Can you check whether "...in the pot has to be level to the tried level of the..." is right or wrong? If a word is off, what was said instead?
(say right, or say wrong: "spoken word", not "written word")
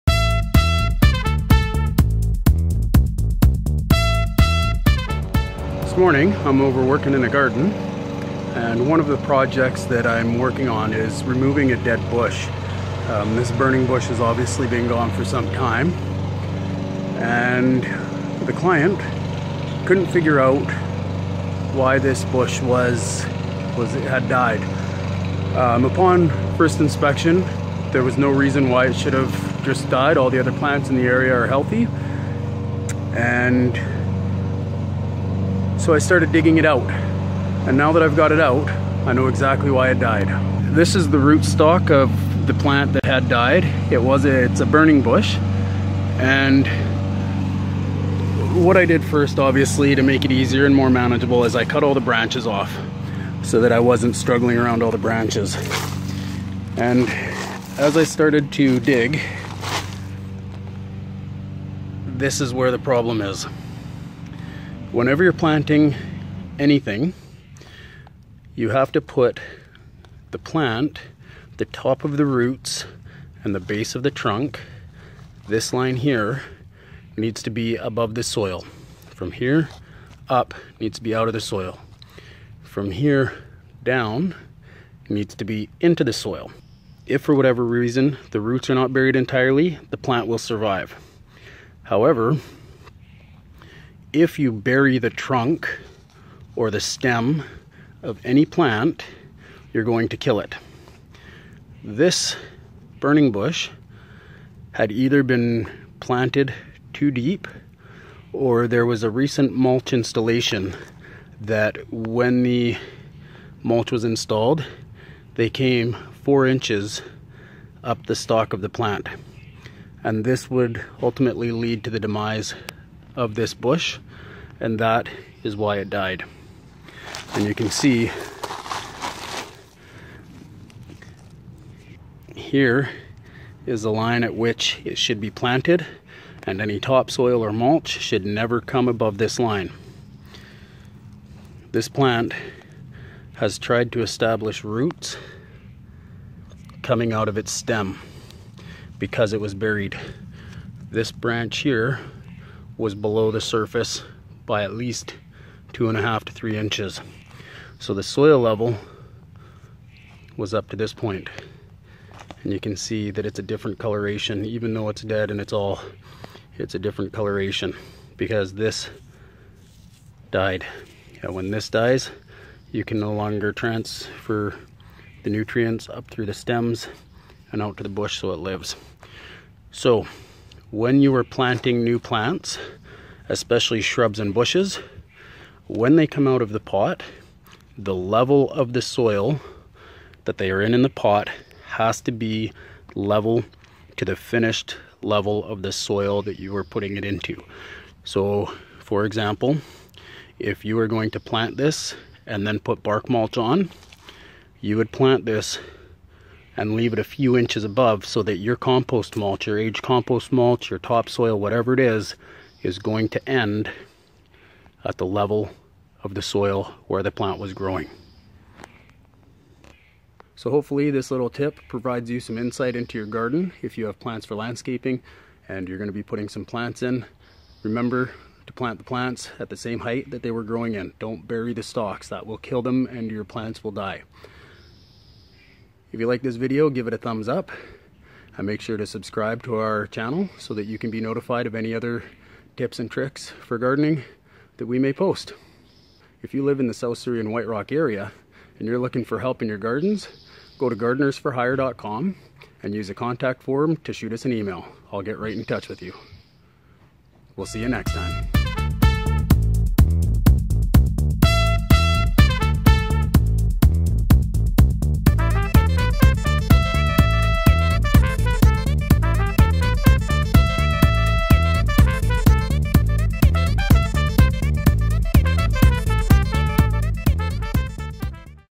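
wrong: "finished", not "tried".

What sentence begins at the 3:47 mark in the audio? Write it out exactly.
Remember to plant the plants at the same height that they were growing in.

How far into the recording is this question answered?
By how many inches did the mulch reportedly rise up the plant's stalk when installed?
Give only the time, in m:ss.
1:56.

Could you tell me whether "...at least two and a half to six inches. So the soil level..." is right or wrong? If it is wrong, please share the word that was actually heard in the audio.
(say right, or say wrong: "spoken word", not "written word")
wrong: "three", not "six".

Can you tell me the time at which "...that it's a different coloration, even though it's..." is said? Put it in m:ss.
2:43.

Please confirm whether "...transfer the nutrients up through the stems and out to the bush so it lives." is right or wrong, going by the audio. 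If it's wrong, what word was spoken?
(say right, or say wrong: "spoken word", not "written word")
right.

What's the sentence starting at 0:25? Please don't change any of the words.
Um, upon first inspection there was no reason why it should have just died.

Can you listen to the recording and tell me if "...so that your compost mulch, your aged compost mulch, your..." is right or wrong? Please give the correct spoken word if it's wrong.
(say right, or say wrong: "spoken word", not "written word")
right.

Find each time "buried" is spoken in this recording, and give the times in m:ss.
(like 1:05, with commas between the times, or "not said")
1:28, 2:29.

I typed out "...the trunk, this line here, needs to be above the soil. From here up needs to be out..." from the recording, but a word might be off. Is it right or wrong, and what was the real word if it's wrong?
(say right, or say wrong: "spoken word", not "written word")
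right.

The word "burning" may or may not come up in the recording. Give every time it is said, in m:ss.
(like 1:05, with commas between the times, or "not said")
0:13, 0:44, 1:42.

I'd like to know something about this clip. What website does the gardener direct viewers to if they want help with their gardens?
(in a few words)
gardenersforhire.com.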